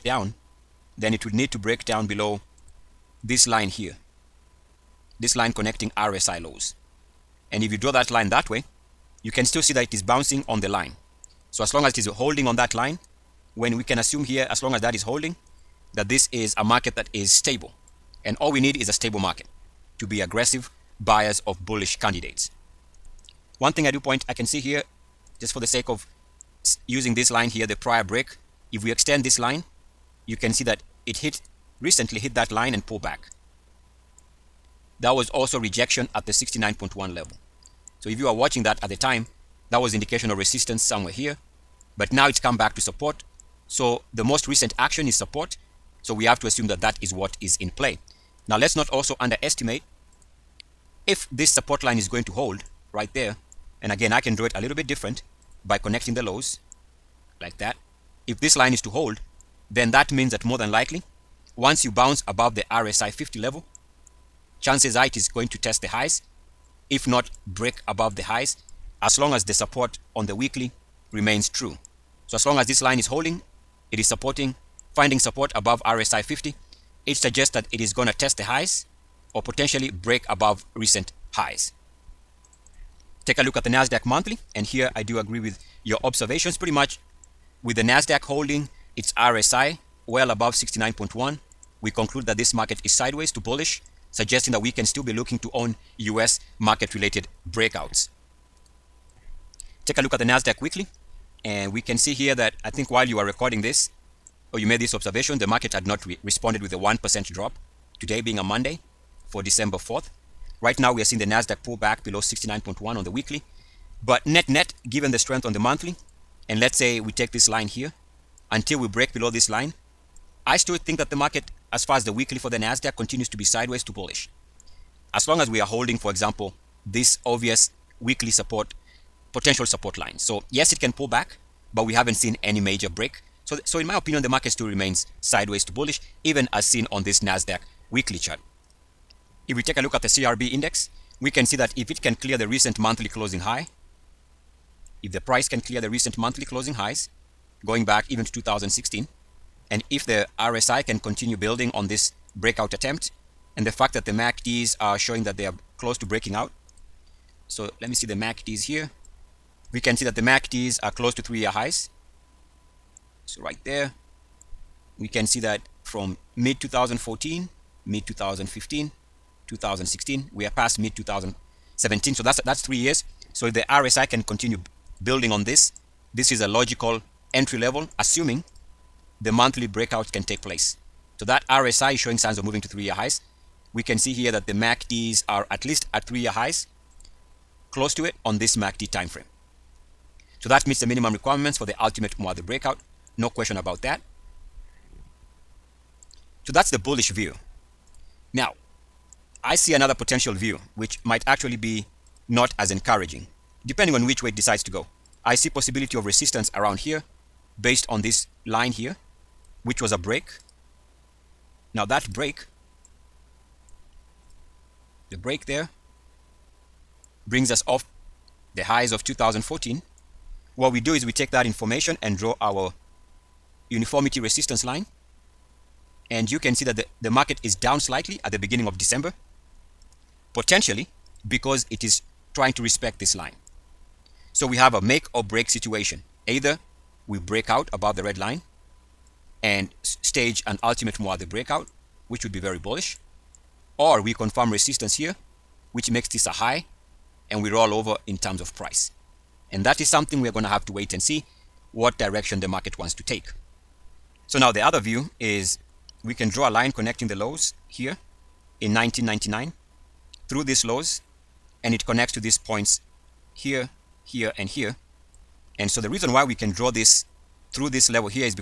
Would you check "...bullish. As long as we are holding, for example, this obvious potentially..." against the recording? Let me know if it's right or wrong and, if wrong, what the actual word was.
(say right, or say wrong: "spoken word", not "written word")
wrong: "weekly", not "potentially".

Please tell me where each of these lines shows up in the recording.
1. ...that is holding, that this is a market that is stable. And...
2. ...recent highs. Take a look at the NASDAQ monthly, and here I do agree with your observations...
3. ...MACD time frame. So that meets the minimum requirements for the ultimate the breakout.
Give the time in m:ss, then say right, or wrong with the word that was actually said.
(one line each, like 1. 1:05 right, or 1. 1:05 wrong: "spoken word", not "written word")
1. 0:14 right
2. 1:20 right
3. 3:08 right.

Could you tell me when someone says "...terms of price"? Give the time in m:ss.
4:08.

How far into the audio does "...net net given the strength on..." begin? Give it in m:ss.
1:54.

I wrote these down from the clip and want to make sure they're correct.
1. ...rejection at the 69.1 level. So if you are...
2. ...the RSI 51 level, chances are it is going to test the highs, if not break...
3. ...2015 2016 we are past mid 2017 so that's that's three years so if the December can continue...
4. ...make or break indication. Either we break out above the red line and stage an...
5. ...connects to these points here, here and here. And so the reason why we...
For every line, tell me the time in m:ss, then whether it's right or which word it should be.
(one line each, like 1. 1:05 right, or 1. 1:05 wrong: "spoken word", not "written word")
1. 0:35 right
2. 1:02 wrong: "50", not "51"
3. 2:48 wrong: "RSI", not "December"
4. 3:54 wrong: "situation", not "indication"
5. 4:21 right.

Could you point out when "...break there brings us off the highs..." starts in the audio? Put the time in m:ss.
3:35.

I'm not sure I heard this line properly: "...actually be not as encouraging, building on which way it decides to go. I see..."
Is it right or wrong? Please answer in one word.
wrong.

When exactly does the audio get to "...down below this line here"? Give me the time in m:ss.
0:01.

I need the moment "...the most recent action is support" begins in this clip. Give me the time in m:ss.
0:44.